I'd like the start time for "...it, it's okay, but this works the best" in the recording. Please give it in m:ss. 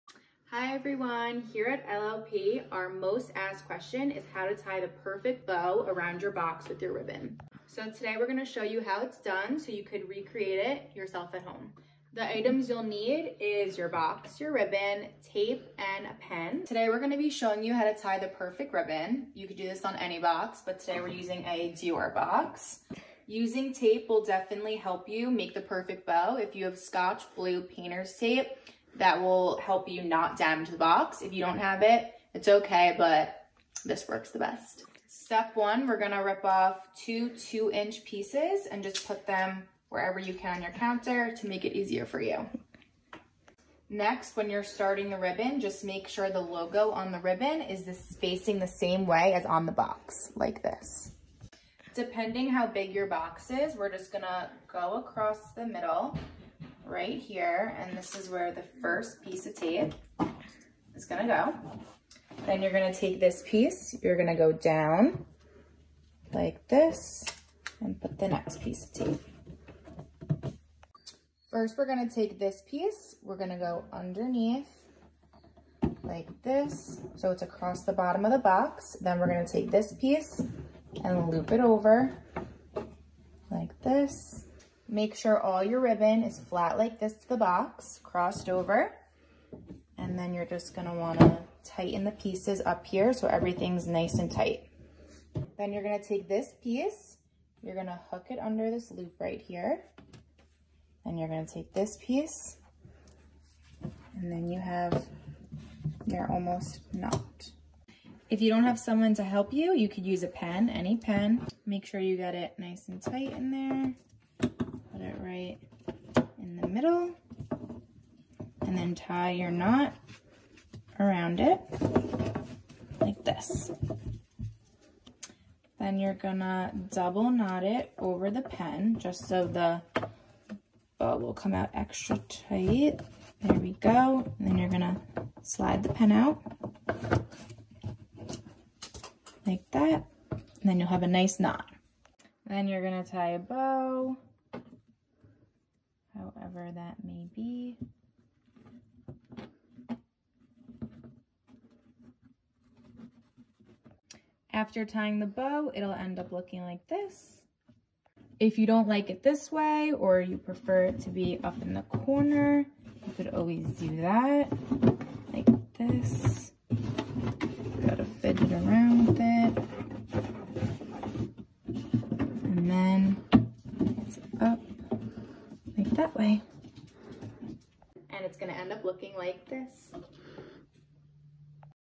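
0:31.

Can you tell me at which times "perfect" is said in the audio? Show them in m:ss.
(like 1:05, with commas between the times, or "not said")
0:04, 0:18, 0:25.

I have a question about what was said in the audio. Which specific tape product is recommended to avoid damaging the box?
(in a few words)
Scotch Blue painter's tape.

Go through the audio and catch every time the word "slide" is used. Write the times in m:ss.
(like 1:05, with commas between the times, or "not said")
2:15.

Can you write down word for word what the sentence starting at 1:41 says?
And you're gonna take this piece, and then you have your almost knot.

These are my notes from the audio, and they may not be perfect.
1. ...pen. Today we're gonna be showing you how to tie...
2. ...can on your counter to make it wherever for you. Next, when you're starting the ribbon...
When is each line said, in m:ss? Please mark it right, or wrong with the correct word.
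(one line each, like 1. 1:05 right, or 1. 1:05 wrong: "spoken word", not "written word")
1. 0:16 right
2. 0:40 wrong: "easier", not "wherever".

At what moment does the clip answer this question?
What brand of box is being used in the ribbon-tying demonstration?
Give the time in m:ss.
0:21.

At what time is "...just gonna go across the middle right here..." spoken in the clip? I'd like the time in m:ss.
0:53.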